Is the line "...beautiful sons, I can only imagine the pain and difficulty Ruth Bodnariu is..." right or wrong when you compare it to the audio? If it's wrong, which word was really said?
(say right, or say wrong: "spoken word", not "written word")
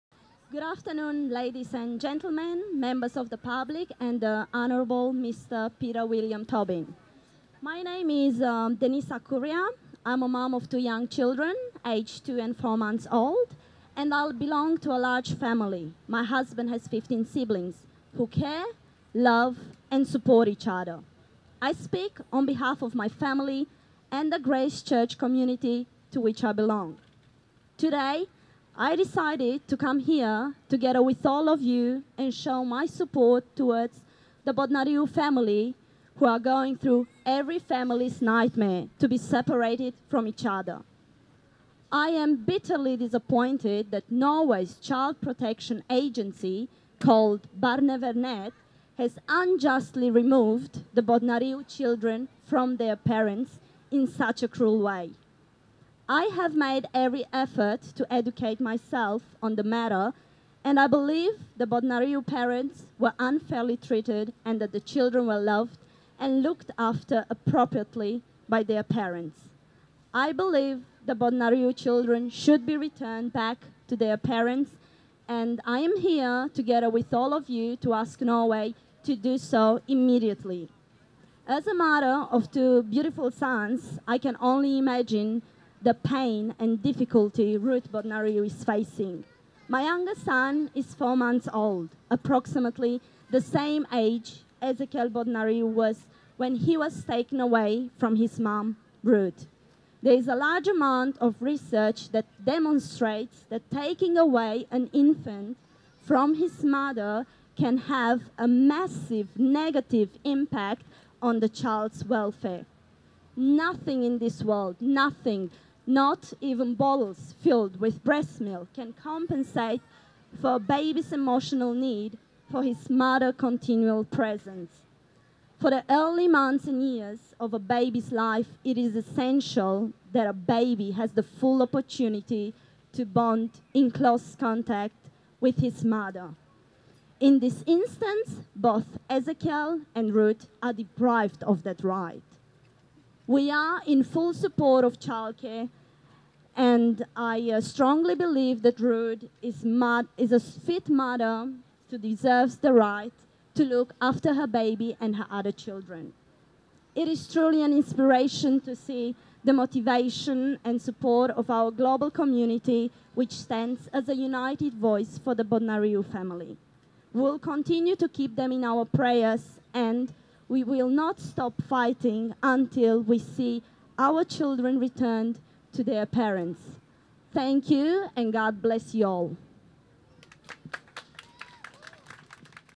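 right.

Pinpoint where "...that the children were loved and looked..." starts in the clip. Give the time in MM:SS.
01:04.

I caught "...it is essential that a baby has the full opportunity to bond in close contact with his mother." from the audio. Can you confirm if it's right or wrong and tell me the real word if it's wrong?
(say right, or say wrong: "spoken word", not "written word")
right.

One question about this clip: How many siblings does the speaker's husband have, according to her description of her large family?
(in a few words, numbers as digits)
15.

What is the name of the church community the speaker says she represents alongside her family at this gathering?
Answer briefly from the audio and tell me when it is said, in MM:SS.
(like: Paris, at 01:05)
Grace Church, at 00:24.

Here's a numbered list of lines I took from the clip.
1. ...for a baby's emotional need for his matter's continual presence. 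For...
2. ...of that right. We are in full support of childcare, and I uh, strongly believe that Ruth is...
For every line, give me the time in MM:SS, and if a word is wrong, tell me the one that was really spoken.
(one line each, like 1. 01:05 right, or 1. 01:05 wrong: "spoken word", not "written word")
1. 02:00 wrong: "mother", not "matter"
2. 02:21 right.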